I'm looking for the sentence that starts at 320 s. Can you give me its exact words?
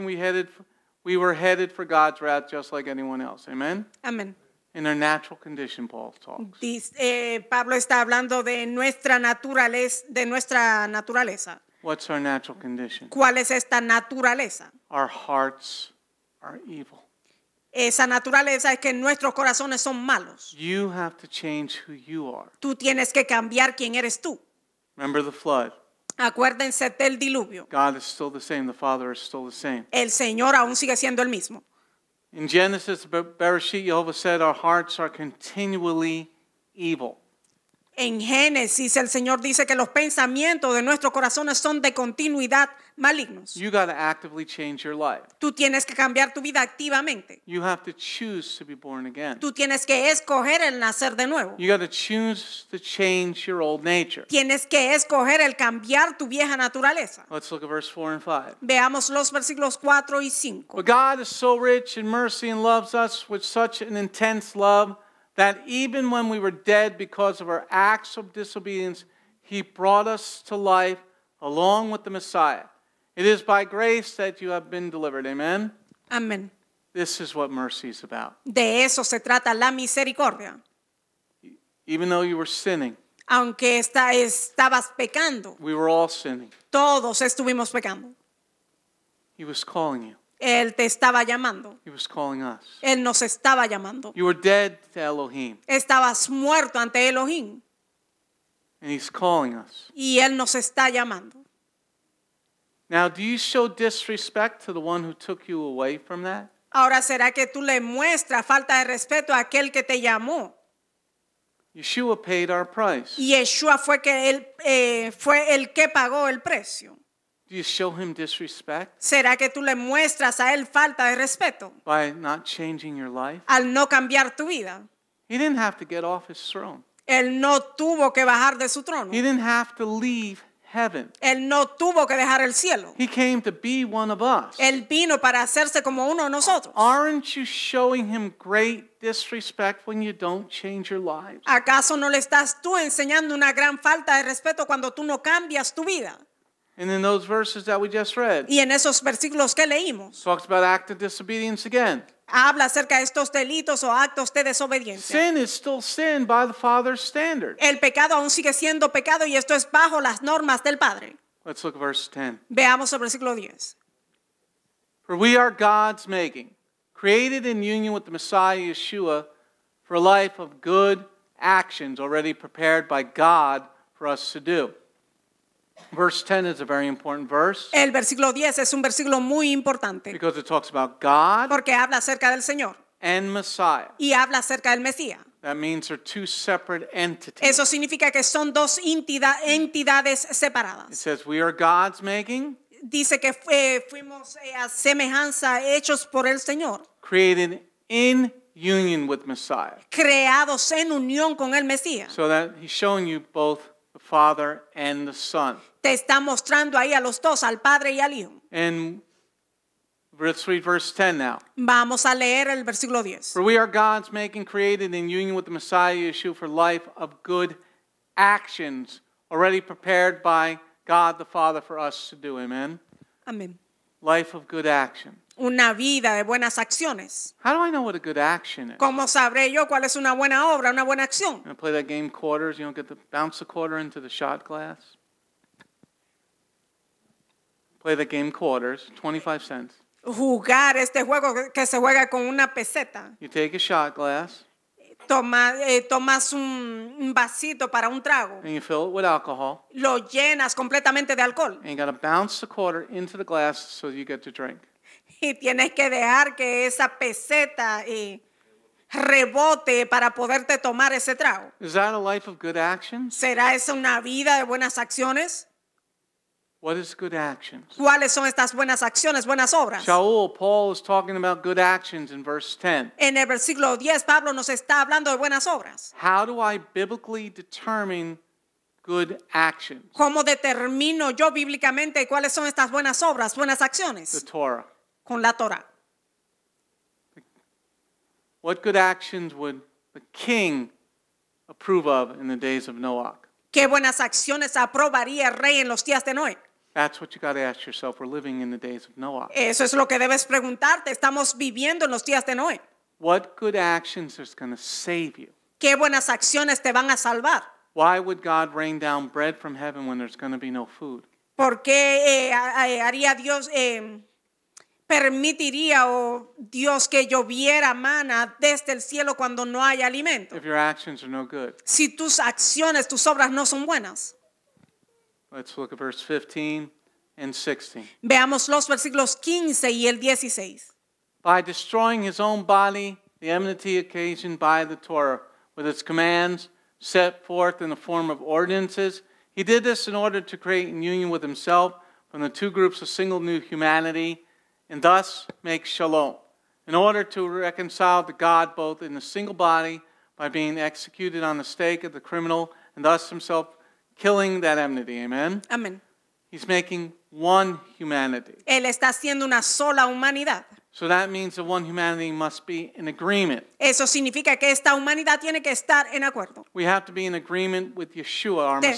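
If your actions are no good.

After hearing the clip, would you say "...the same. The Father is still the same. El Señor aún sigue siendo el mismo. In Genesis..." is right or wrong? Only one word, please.
right.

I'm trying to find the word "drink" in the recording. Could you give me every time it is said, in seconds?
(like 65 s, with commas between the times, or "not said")
254 s.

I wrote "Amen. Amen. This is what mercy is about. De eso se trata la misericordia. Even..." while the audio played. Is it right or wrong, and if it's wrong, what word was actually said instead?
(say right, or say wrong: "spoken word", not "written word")
right.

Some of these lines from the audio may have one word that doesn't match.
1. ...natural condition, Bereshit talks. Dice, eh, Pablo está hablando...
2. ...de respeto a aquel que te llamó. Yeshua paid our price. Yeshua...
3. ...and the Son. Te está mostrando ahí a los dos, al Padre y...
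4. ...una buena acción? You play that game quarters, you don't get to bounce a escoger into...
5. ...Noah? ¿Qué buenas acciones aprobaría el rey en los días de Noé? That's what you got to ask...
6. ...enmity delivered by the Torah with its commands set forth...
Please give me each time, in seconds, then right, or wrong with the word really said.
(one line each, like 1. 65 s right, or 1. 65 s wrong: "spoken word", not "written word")
1. 4 s wrong: "Paul", not "Bereshit"
2. 108 s right
3. 204 s right
4. 230 s wrong: "quarter", not "escoger"
5. 292 s right
6. 333 s wrong: "occasioned", not "delivered".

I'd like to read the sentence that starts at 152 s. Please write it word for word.
habla acerca de estos delitos o actos de desobediencia.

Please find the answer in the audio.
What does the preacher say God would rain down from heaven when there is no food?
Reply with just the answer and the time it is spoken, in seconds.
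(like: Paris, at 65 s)
Bread, at 309 s.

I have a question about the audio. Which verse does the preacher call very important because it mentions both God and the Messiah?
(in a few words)
Verse 10.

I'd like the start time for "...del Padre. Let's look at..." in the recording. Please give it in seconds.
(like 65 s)
160 s.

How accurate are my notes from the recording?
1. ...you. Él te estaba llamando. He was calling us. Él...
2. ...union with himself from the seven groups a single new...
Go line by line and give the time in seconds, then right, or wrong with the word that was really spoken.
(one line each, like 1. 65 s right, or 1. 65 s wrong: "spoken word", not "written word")
1. 90 s right
2. 340 s wrong: "two", not "seven".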